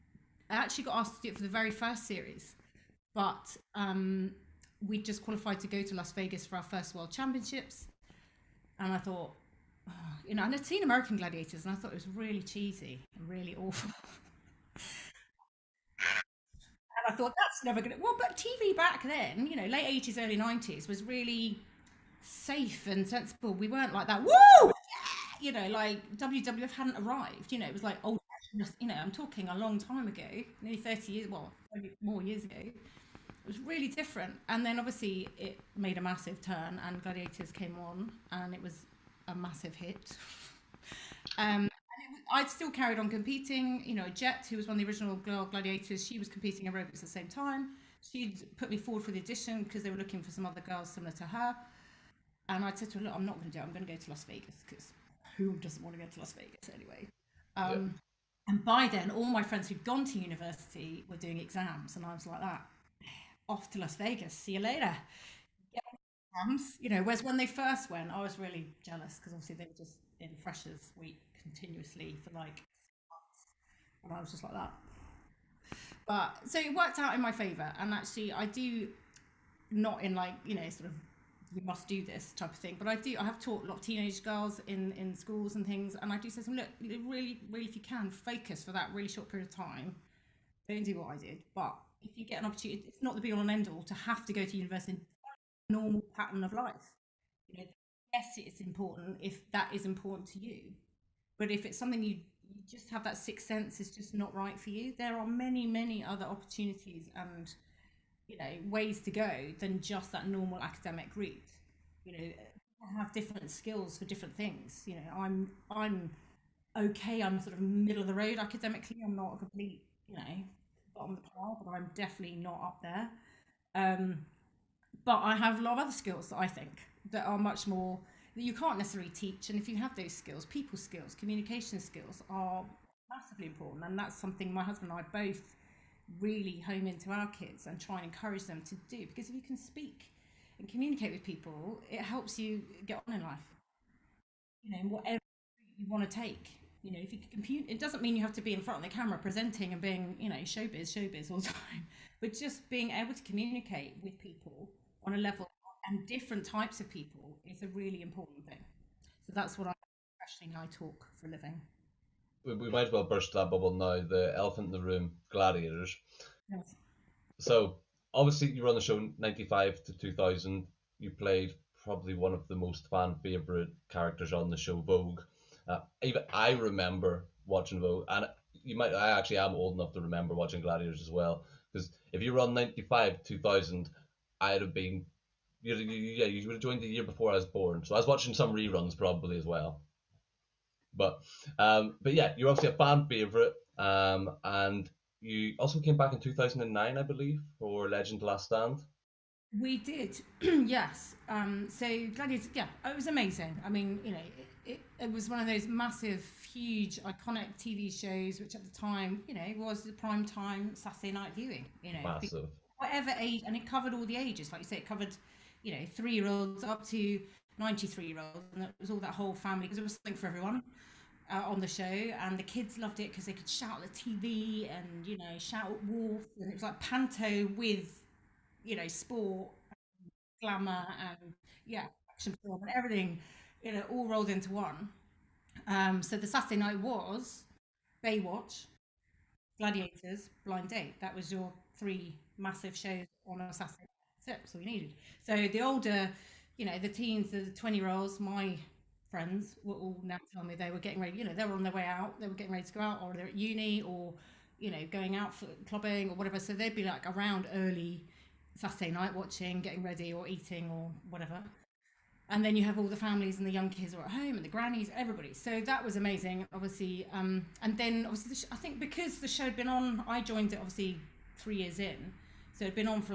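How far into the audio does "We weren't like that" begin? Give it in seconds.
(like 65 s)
23 s.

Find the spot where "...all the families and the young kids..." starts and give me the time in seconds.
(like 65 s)
262 s.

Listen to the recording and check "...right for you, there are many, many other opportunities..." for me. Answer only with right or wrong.
right.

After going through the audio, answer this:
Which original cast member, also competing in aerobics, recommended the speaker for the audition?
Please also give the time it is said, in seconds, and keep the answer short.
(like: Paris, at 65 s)
Jet, at 44 s.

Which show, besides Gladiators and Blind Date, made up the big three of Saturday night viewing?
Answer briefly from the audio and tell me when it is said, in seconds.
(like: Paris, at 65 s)
Baywatch, at 238 s.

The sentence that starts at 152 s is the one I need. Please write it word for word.
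But just being able to communicate with people on a level and different types of people is a really important thing.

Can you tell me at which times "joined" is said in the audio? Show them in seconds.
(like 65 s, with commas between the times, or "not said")
186 s, 270 s.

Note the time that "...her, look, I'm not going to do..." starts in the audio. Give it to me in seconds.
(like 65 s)
52 s.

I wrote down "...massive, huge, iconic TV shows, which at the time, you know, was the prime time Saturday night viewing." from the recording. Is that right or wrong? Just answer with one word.
right.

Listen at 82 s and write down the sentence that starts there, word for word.
But I do, I have taught a lot of teenage girls in, in schools and things.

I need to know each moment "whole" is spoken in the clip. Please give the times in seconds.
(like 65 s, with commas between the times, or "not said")
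219 s.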